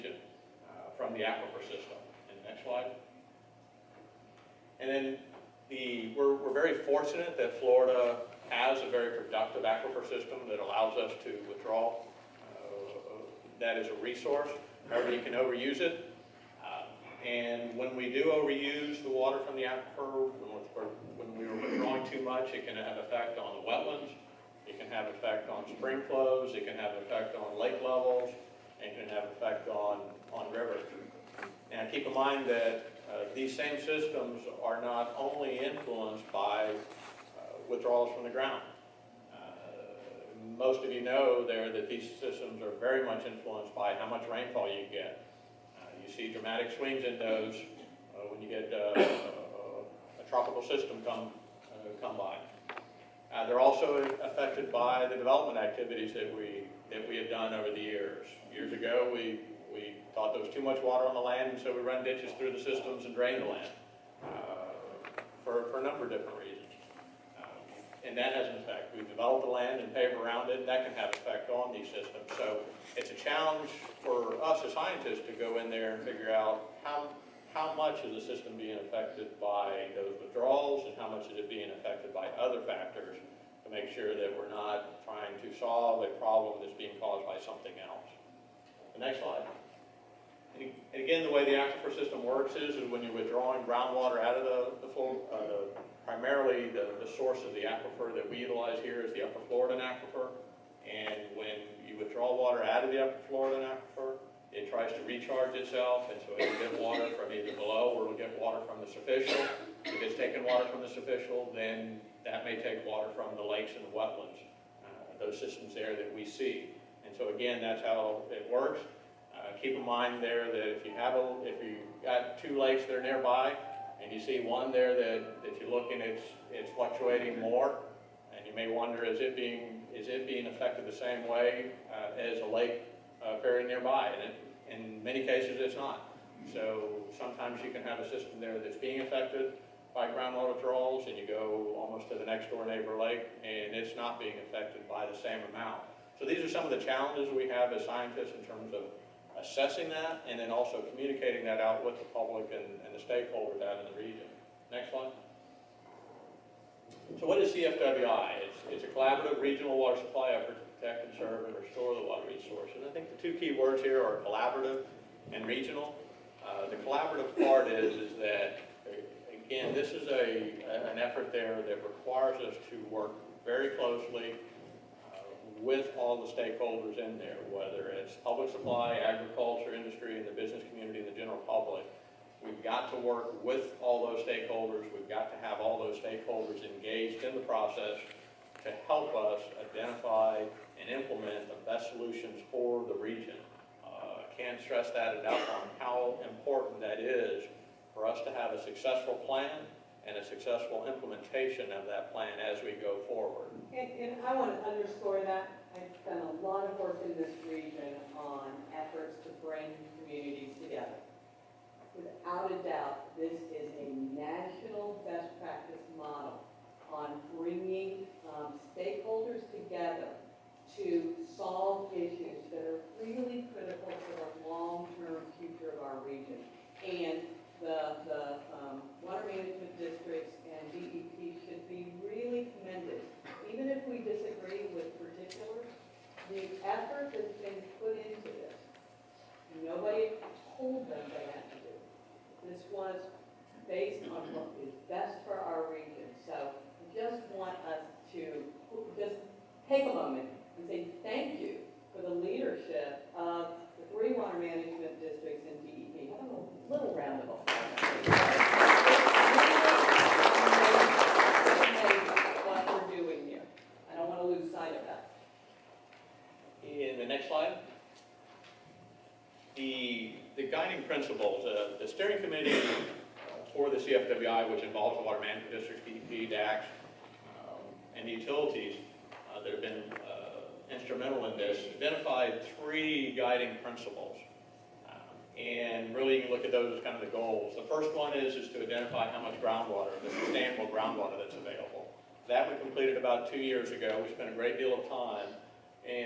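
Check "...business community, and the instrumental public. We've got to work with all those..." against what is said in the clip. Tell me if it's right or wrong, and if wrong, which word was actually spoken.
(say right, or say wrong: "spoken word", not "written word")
wrong: "general", not "instrumental".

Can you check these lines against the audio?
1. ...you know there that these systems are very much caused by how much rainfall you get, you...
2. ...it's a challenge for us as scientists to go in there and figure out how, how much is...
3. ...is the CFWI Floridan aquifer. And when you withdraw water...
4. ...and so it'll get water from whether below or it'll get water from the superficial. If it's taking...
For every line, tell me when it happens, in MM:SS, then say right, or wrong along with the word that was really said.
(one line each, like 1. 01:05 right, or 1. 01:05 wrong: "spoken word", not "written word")
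1. 00:40 wrong: "influenced", not "caused"
2. 01:12 right
3. 01:39 wrong: "Upper", not "CFWI"
4. 01:46 wrong: "either", not "whether".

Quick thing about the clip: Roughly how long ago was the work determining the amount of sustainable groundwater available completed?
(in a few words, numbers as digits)
about 2 years ago.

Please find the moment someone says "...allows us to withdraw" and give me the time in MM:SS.
00:10.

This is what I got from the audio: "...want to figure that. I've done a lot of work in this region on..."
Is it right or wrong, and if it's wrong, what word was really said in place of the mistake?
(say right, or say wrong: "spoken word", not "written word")
wrong: "underscore", not "figure".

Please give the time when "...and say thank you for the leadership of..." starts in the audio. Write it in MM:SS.
04:10.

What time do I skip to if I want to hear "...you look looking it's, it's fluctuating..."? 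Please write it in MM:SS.
02:05.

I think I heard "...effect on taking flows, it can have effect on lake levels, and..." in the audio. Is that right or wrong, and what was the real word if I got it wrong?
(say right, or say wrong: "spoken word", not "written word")
wrong: "spring", not "taking".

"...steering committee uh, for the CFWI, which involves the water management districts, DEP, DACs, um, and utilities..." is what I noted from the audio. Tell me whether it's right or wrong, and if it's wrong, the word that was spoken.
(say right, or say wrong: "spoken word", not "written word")
right.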